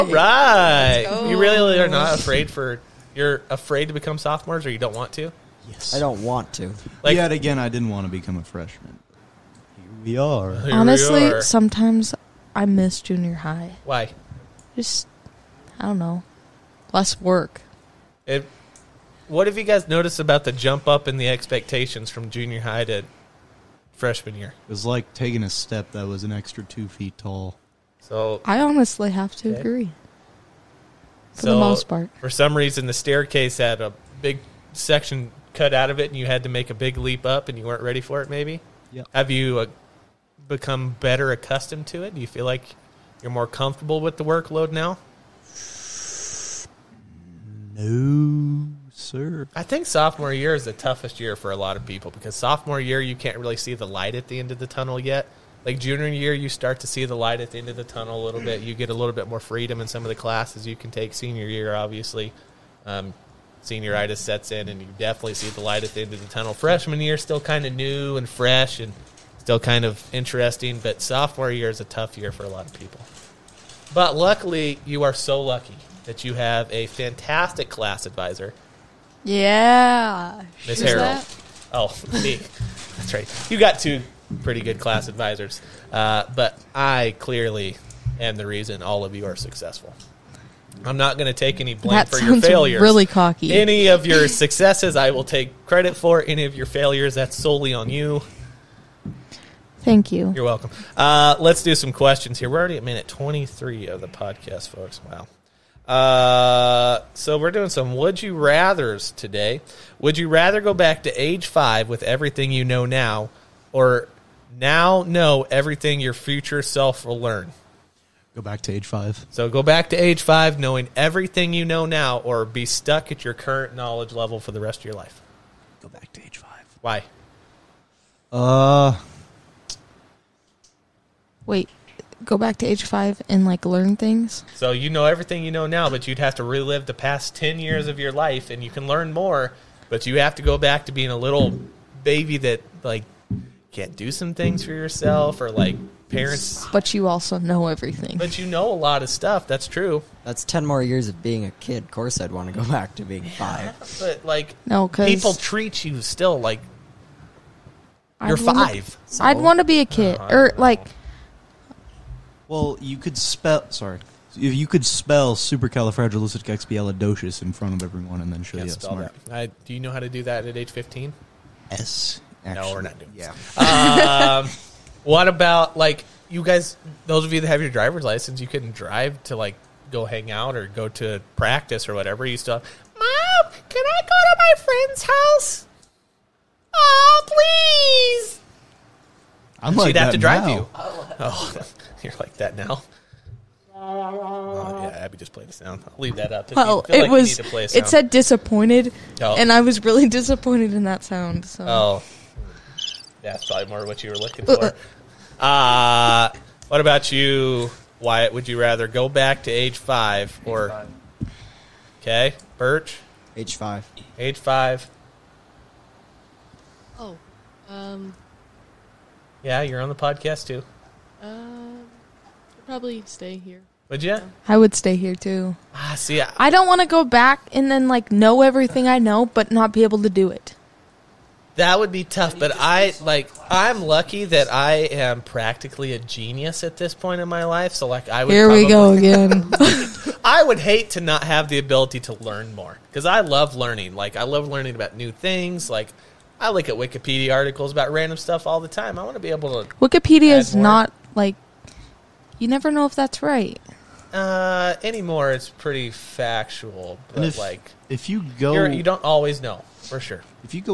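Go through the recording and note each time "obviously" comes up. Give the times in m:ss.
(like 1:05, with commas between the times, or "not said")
1:01.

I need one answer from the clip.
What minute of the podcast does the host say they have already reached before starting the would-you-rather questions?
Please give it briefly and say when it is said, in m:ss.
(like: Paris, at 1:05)
23, at 1:42.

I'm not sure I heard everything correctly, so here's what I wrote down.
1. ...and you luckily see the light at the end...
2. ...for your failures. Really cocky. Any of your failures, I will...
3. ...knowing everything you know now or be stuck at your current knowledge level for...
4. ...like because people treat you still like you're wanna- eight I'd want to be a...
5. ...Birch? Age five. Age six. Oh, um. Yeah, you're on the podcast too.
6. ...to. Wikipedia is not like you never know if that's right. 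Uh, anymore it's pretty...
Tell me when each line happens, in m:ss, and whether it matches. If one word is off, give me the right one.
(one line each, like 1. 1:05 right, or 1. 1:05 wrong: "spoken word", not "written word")
1. 1:04 wrong: "definitely", not "luckily"
2. 1:32 wrong: "successes", not "failures"
3. 2:00 right
4. 2:34 wrong: "five", not "eight"
5. 3:32 wrong: "five", not "six"
6. 4:09 right.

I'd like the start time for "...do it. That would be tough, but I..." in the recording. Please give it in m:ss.
3:50.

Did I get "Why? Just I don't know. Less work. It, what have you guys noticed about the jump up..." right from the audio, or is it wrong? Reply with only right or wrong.
right.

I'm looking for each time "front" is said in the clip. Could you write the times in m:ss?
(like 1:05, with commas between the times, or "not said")
2:47.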